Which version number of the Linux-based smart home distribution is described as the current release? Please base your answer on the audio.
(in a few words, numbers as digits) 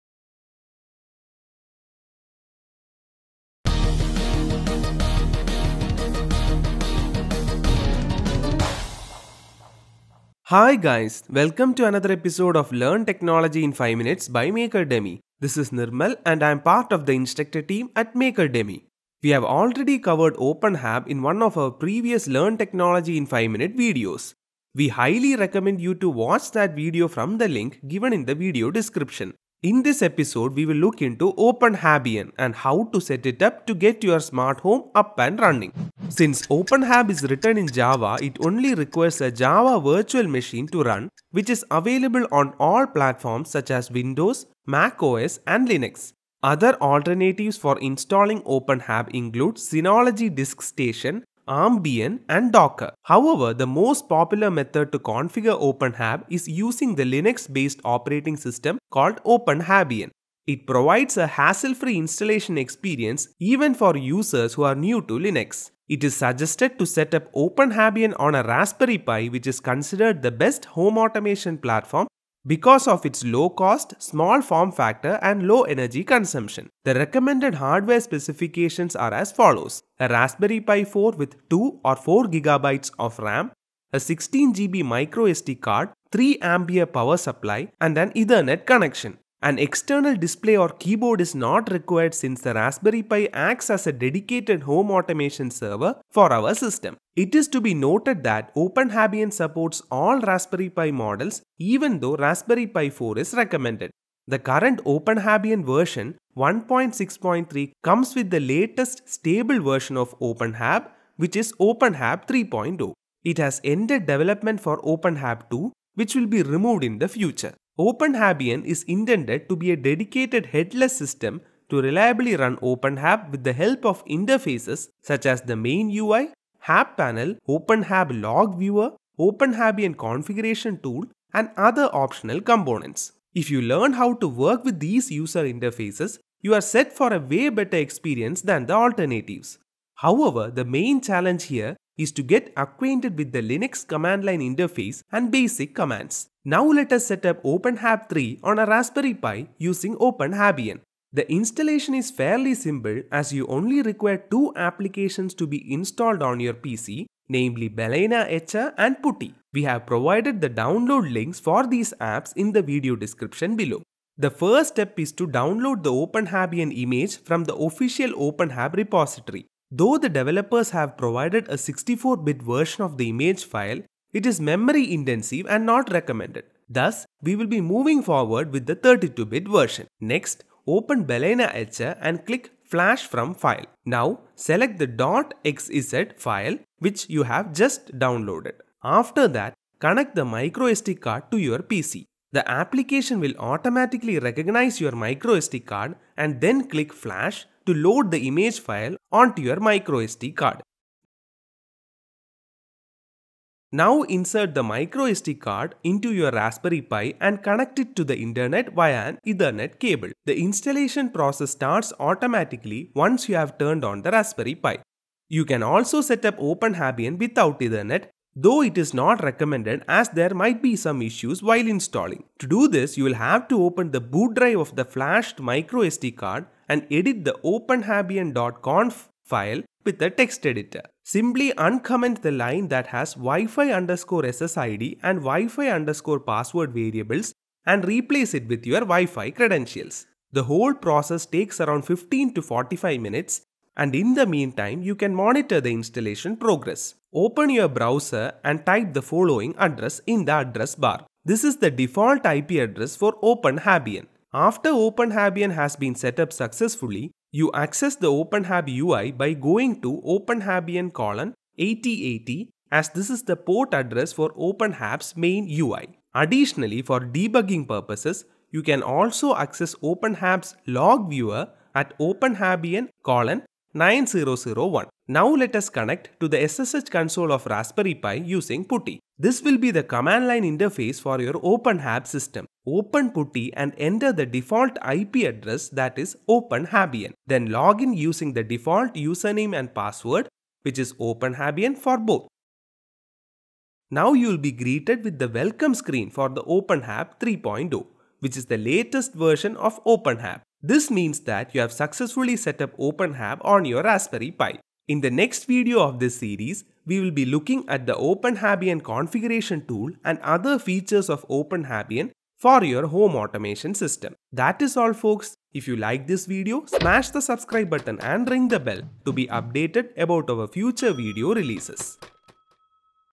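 1.6.3.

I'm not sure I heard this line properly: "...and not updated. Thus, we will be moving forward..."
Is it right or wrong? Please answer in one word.
wrong.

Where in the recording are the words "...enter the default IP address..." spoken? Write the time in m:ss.
4:43.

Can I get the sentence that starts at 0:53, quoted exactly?
However, the most popular method to configure OpenHAB is using the Linux-based operating system called OpenHABian.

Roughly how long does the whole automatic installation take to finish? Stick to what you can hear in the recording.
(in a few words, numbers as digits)
15 to 45 minutes.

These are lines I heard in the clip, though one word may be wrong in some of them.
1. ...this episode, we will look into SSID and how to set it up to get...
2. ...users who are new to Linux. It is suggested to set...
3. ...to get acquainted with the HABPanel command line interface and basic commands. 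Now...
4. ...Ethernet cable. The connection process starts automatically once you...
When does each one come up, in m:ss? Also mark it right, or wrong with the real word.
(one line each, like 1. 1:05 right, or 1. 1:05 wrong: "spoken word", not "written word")
1. 0:29 wrong: "OpenHabian", not "SSID"
2. 1:03 right
3. 2:22 wrong: "Linux", not "HABPanel"
4. 3:29 wrong: "installation", not "connection".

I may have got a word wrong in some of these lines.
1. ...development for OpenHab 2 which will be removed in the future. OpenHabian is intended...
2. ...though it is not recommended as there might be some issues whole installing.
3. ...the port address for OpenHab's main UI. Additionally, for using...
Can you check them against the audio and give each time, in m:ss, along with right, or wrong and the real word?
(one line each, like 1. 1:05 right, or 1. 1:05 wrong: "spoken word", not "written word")
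1. 1:54 right
2. 3:38 wrong: "while", not "whole"
3. 4:23 wrong: "debugging", not "using".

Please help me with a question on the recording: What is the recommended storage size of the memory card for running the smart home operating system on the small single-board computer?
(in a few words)
16 GB.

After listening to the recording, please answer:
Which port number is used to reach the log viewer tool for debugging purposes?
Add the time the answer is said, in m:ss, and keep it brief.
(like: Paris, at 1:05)
9001, at 4:33.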